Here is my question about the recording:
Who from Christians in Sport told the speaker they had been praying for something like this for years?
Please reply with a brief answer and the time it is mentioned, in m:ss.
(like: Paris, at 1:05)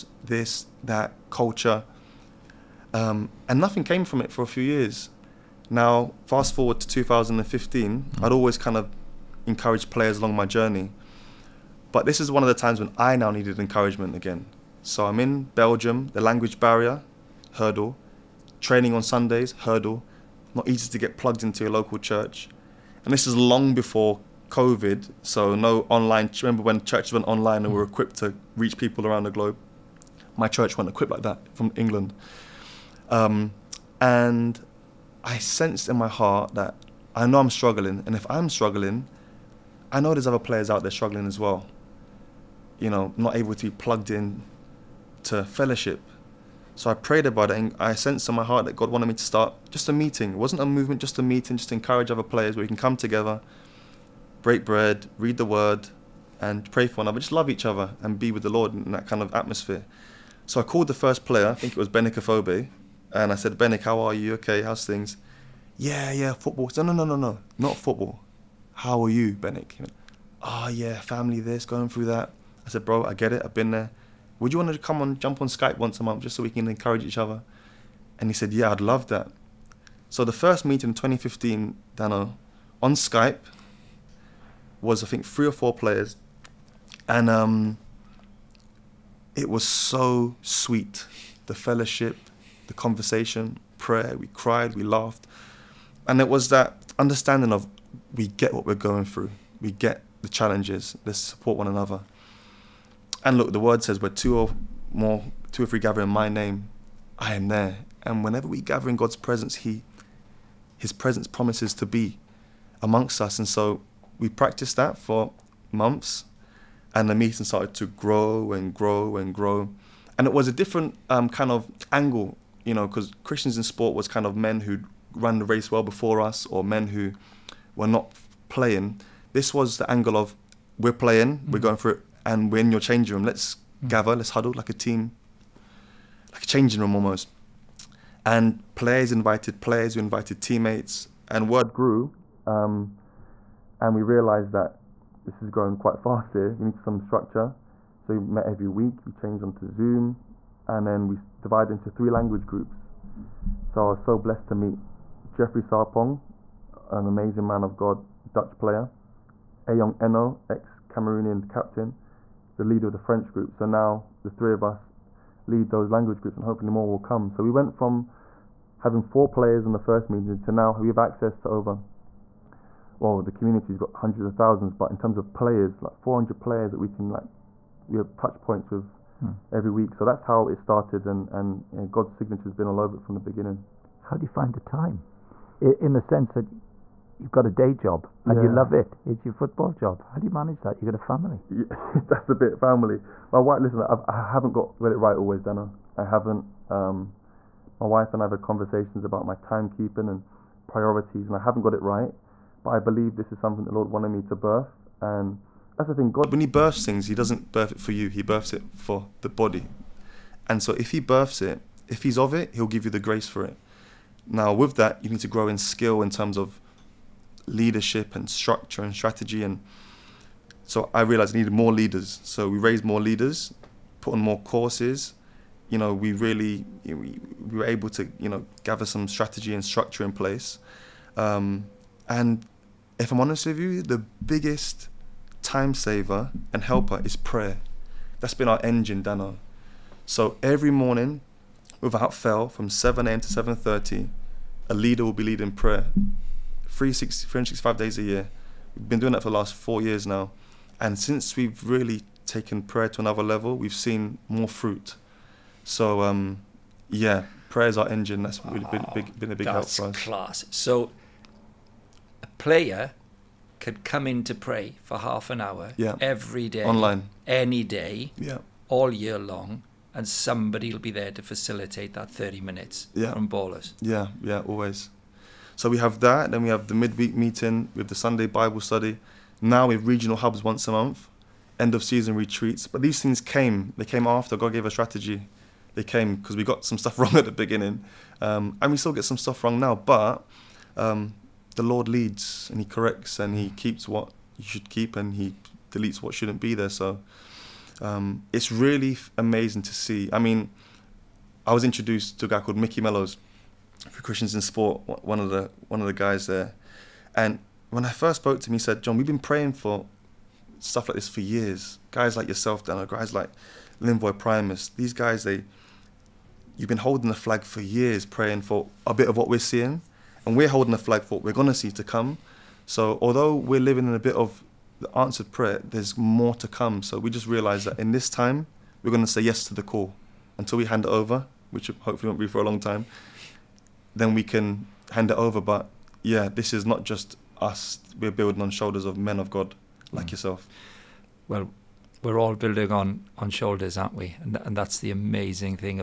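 Mickey Mellows, at 5:02.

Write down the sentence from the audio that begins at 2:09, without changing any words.
This was the angle of we're playing, mm-hmm.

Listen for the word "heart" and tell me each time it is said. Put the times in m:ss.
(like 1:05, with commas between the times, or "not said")
0:36, 0:48.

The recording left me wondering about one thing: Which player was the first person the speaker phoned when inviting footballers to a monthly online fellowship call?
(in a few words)
Benik Afobe.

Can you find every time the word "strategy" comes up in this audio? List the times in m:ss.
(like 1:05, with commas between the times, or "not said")
3:38, 3:49, 4:44.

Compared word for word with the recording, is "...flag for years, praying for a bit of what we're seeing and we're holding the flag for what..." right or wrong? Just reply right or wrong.
right.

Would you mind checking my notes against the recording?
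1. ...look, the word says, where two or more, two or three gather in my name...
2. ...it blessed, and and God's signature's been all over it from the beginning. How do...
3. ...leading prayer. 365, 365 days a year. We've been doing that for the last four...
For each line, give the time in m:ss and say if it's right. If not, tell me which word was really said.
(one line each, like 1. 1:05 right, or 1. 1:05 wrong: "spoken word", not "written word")
1. 1:43 right
2. 3:00 wrong: "started", not "blessed"
3. 4:05 wrong: "360", not "365".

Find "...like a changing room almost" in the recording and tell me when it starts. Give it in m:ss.
2:16.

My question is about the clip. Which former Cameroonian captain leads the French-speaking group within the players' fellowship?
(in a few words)
Eyong Enoh.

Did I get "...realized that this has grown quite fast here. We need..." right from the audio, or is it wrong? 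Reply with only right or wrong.
right.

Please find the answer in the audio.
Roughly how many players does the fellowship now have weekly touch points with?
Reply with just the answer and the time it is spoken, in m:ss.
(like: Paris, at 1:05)
400, at 2:55.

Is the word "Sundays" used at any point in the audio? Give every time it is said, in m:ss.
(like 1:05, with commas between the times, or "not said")
0:19, 4:37.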